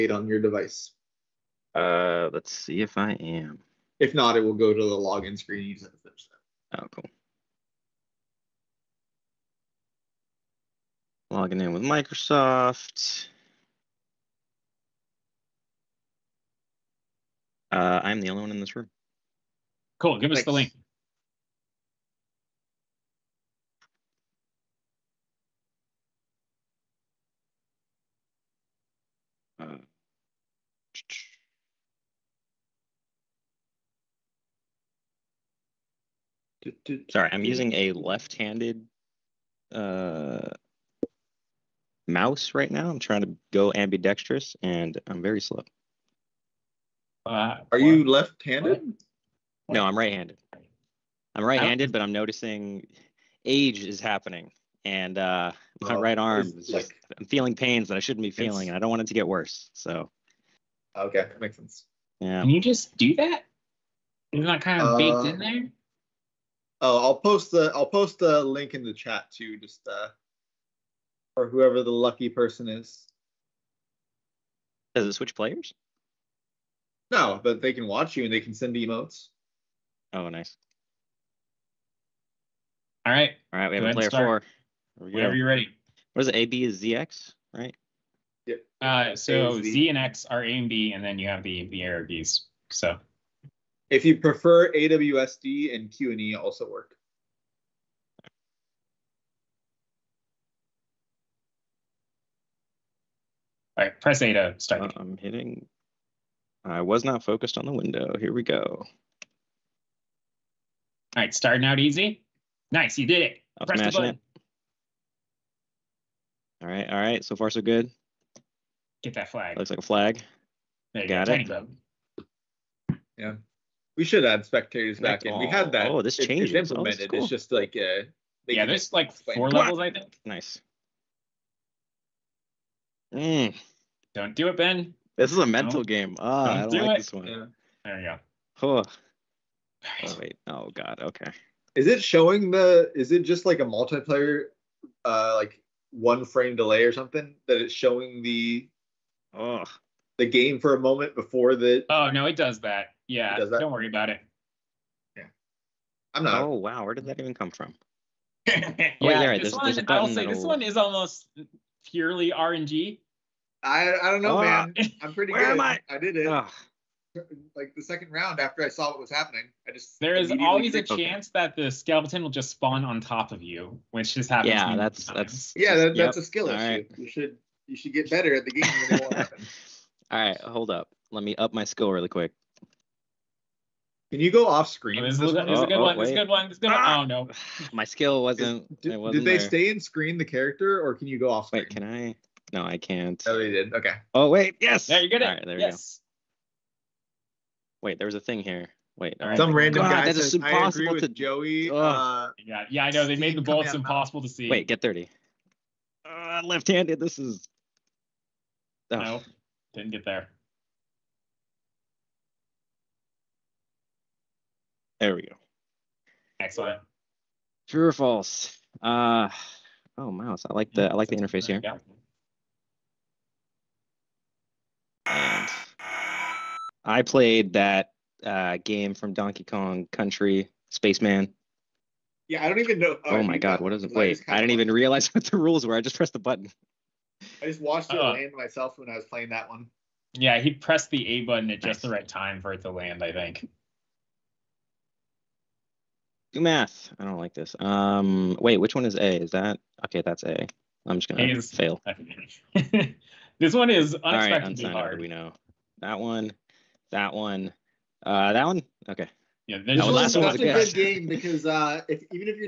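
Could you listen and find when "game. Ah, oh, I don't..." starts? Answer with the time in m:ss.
2:15.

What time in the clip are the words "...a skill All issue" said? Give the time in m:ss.
2:56.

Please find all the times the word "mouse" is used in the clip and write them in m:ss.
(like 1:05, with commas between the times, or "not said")
0:42, 3:40.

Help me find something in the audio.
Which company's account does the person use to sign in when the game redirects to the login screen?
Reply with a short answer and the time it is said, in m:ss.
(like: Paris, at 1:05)
Microsoft, at 0:11.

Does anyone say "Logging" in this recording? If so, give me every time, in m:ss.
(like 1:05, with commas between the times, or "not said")
0:11.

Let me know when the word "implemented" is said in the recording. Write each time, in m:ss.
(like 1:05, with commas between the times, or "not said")
2:06.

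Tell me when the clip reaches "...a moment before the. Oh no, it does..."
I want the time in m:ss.
2:30.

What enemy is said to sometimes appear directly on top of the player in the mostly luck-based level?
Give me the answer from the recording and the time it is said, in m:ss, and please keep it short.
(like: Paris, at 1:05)
skeleton, at 2:51.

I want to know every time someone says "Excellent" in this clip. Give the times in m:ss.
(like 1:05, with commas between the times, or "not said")
3:36.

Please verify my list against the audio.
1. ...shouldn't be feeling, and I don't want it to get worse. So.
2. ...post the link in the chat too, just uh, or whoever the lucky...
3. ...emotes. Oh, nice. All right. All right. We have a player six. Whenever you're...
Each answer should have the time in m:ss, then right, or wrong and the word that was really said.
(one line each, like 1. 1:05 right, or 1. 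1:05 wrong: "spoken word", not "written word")
1. 0:58 right
2. 1:07 right
3. 1:18 wrong: "four", not "six".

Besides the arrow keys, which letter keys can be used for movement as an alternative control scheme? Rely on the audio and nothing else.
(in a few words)
AWSD.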